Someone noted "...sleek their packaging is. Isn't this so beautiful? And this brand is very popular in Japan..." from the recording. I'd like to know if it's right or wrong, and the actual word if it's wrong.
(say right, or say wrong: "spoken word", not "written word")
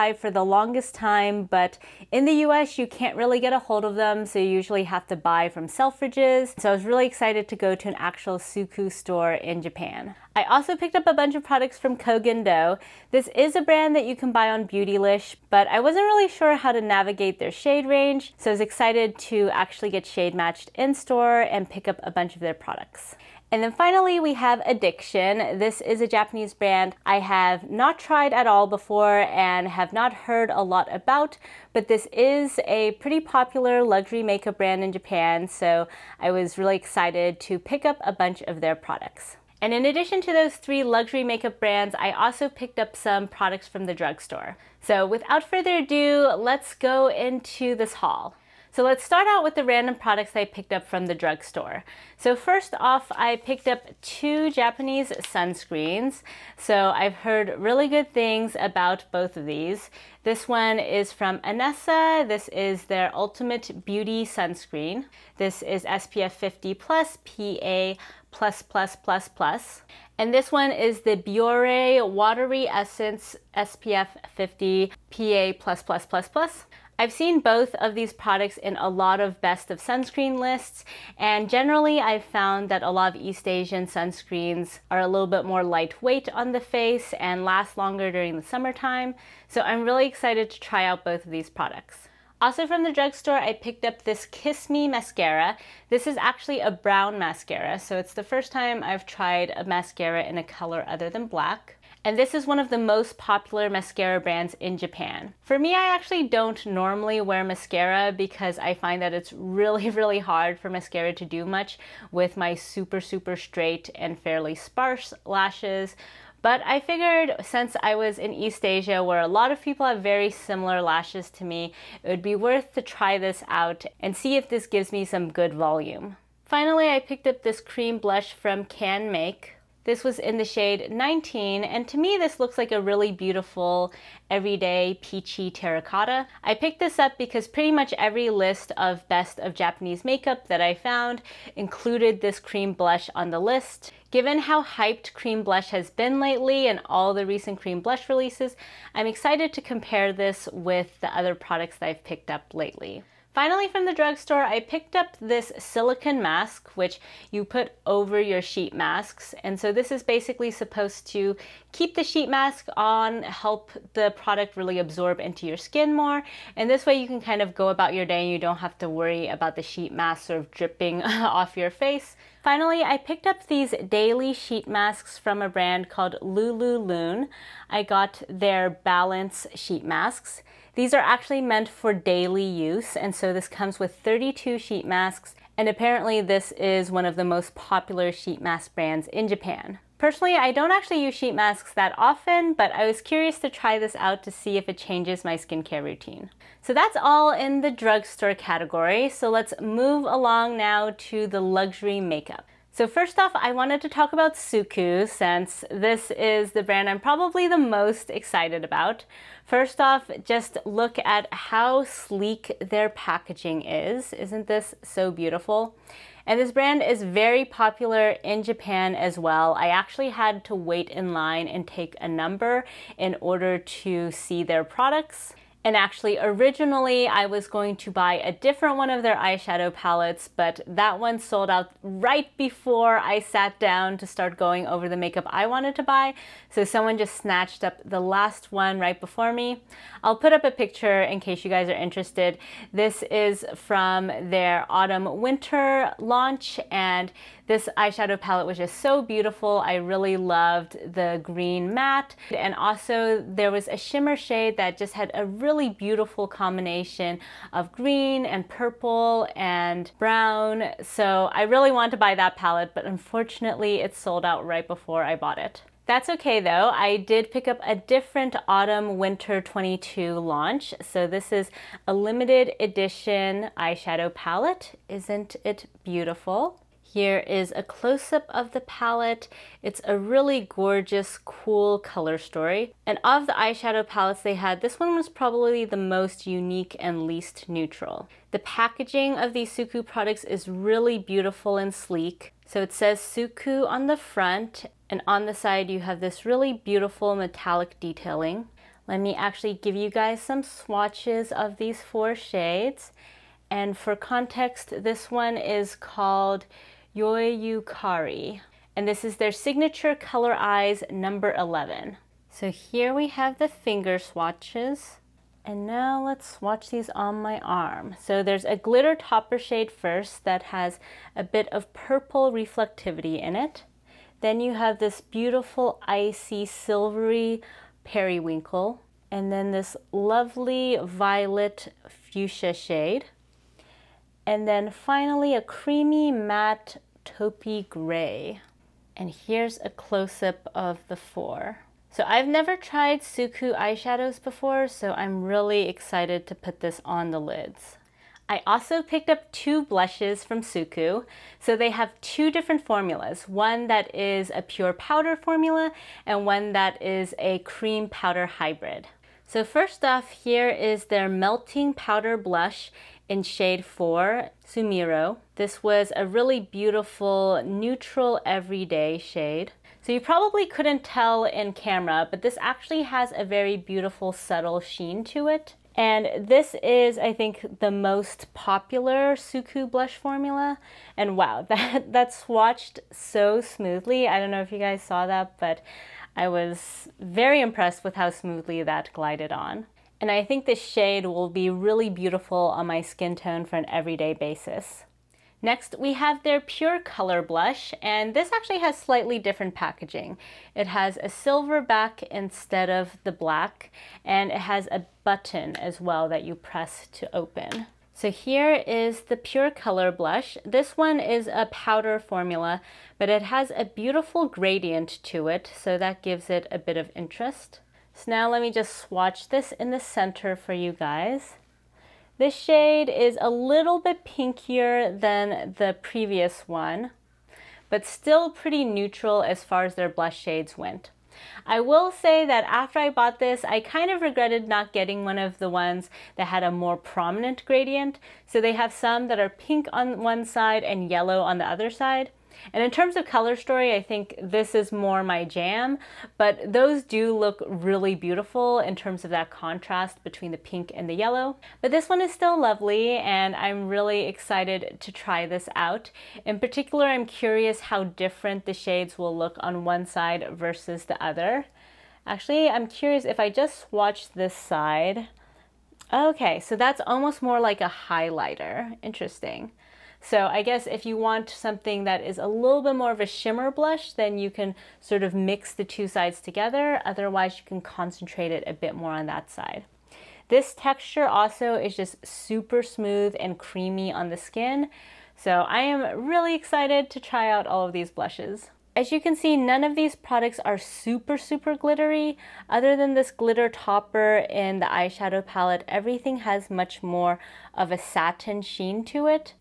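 right.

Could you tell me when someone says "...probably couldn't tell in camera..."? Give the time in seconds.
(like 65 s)
370 s.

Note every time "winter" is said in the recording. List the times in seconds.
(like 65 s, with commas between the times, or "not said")
245 s, 268 s.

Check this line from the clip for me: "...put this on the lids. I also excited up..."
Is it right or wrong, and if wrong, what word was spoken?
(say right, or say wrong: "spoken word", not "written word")
wrong: "picked", not "excited".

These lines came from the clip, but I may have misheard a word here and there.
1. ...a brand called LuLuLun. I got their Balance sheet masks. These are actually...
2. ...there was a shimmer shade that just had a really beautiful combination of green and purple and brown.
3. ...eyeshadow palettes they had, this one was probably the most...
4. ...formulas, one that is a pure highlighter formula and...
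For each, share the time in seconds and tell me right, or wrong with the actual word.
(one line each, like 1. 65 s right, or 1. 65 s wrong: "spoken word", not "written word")
1. 175 s right
2. 253 s right
3. 283 s right
4. 352 s wrong: "powder", not "highlighter".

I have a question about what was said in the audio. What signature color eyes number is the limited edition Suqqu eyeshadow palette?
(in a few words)
11.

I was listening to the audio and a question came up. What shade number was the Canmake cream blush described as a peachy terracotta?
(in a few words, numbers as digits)
19.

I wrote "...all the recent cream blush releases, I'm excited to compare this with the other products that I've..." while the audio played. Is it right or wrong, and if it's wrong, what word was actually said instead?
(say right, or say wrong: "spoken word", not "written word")
right.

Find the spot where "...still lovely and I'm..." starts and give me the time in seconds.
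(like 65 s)
452 s.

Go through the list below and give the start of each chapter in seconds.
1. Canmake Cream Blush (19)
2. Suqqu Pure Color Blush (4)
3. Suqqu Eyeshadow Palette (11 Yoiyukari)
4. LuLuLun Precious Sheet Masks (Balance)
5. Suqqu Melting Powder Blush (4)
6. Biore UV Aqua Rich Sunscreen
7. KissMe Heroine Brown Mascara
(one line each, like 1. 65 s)
1. 125 s
2. 394 s
3. 202 s
4. 171 s
5. 347 s
6. 48 s
7. 91 s.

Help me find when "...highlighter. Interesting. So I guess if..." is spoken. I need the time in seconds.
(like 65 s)
467 s.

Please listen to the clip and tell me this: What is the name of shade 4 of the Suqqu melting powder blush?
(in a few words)
Sumiro.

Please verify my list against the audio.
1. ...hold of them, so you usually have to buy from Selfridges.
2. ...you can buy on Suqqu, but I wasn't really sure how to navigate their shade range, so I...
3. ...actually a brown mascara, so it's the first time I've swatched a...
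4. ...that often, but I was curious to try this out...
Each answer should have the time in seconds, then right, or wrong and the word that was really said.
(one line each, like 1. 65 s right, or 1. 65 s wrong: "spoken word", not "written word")
1. 3 s right
2. 14 s wrong: "Beautylish", not "Suqqu"
3. 96 s wrong: "tried", not "swatched"
4. 191 s right.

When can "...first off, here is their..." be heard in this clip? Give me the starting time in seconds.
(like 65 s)
359 s.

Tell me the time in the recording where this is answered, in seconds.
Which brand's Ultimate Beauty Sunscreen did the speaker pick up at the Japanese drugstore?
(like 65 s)
61 s.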